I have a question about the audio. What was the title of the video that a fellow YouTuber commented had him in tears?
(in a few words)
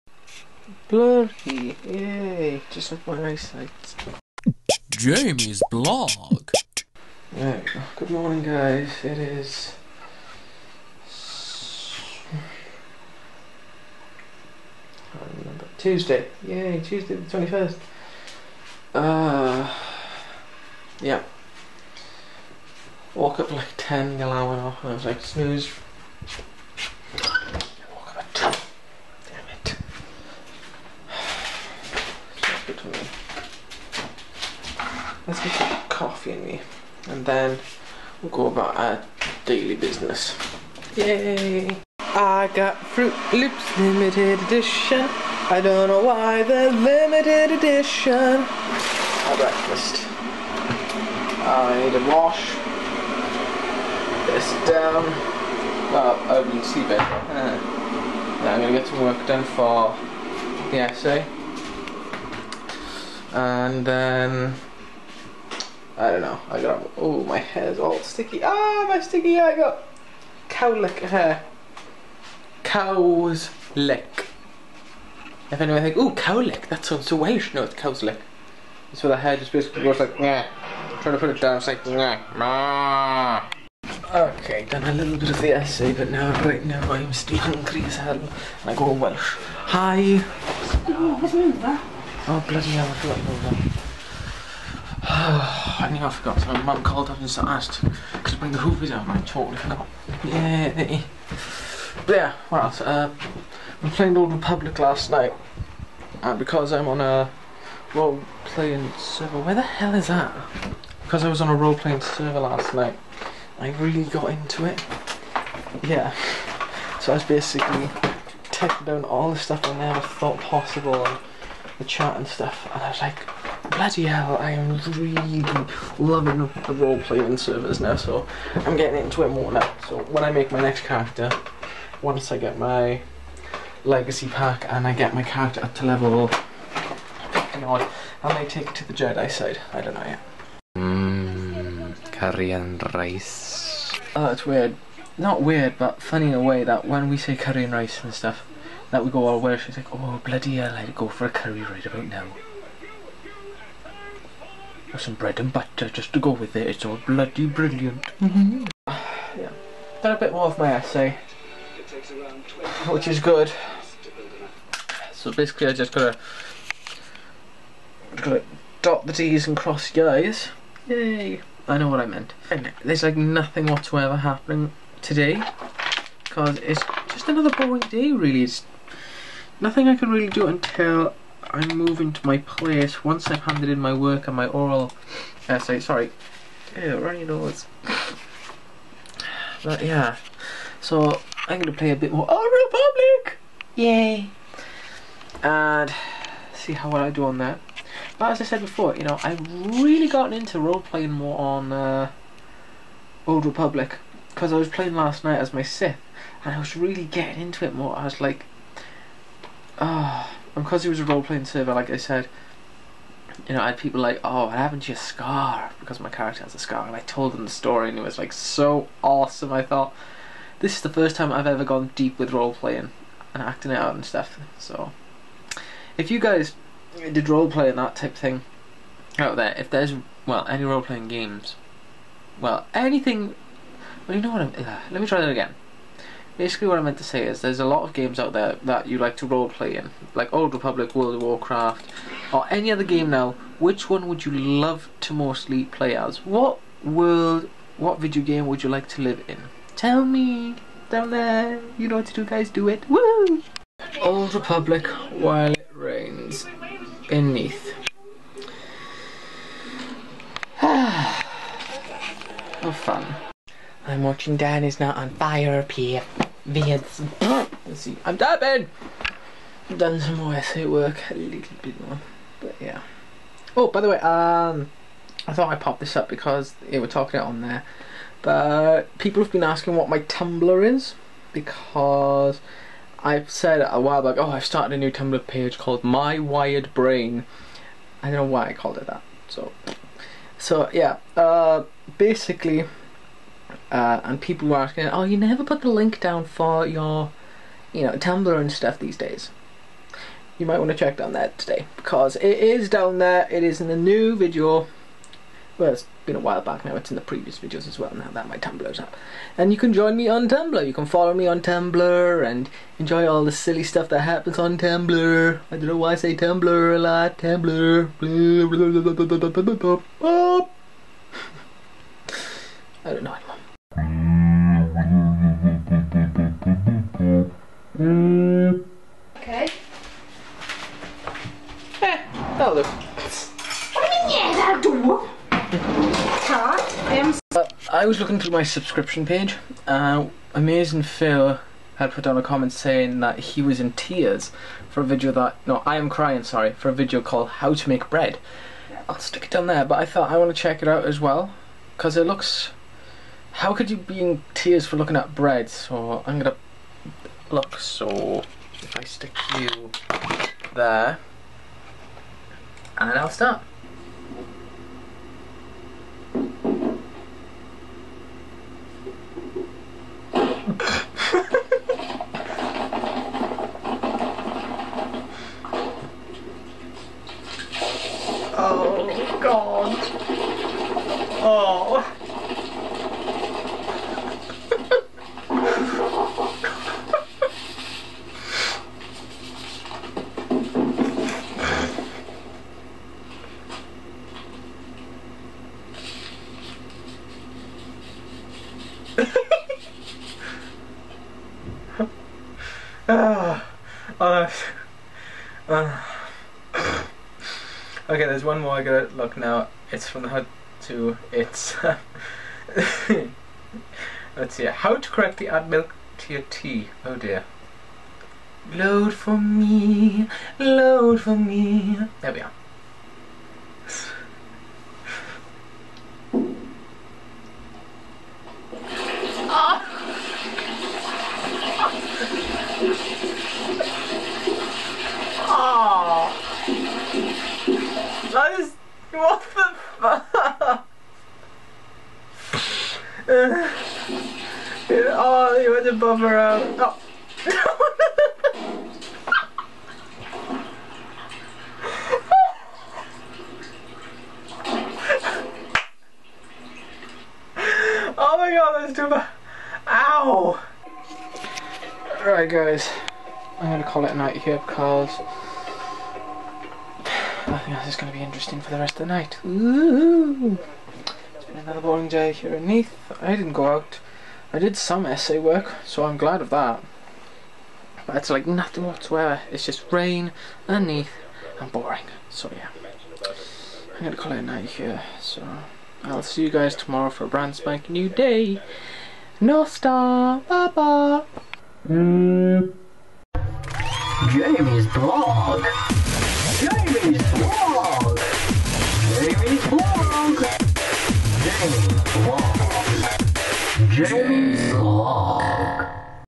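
How to Make Bread.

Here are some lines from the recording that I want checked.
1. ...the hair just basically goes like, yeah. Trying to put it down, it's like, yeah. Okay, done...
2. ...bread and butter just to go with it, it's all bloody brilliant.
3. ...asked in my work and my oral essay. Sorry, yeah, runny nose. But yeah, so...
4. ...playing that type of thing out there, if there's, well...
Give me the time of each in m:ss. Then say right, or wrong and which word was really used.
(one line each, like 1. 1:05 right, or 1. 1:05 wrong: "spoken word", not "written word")
1. 1:19 right
2. 2:35 right
3. 3:03 wrong: "handed", not "asked"
4. 3:47 right.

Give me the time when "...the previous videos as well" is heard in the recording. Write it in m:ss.
5:06.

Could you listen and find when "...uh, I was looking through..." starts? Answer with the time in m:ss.
5:37.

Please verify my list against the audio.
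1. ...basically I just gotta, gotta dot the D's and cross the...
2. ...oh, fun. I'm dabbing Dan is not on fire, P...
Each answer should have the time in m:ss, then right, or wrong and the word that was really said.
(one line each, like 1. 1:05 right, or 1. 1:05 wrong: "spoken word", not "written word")
1. 2:45 right
2. 4:22 wrong: "watching", not "dabbing".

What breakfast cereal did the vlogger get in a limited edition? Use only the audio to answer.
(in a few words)
Froot Loops.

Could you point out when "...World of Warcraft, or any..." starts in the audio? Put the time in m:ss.
4:00.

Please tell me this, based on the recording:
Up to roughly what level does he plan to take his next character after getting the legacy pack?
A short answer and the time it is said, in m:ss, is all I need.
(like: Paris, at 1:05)
50, at 2:15.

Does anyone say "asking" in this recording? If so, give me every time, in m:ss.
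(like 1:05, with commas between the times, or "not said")
4:39, 4:54.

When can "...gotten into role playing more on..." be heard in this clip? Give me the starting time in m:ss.
3:20.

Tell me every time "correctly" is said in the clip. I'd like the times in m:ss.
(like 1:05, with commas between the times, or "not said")
6:54.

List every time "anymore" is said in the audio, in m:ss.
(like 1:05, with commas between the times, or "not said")
5:23.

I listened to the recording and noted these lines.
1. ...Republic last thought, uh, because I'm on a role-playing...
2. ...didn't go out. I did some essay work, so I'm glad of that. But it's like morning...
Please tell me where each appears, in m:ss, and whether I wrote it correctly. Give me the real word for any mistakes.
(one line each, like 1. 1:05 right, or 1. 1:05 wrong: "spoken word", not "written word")
1. 1:44 wrong: "night", not "thought"
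2. 7:53 wrong: "nothing", not "morning".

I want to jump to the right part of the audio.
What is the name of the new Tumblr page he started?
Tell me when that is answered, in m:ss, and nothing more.
4:45.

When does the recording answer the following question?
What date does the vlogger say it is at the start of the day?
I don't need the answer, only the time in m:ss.
0:16.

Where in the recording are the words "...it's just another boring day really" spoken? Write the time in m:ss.
2:56.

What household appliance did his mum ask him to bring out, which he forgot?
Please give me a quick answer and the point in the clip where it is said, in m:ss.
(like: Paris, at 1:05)
The hoover, at 1:38.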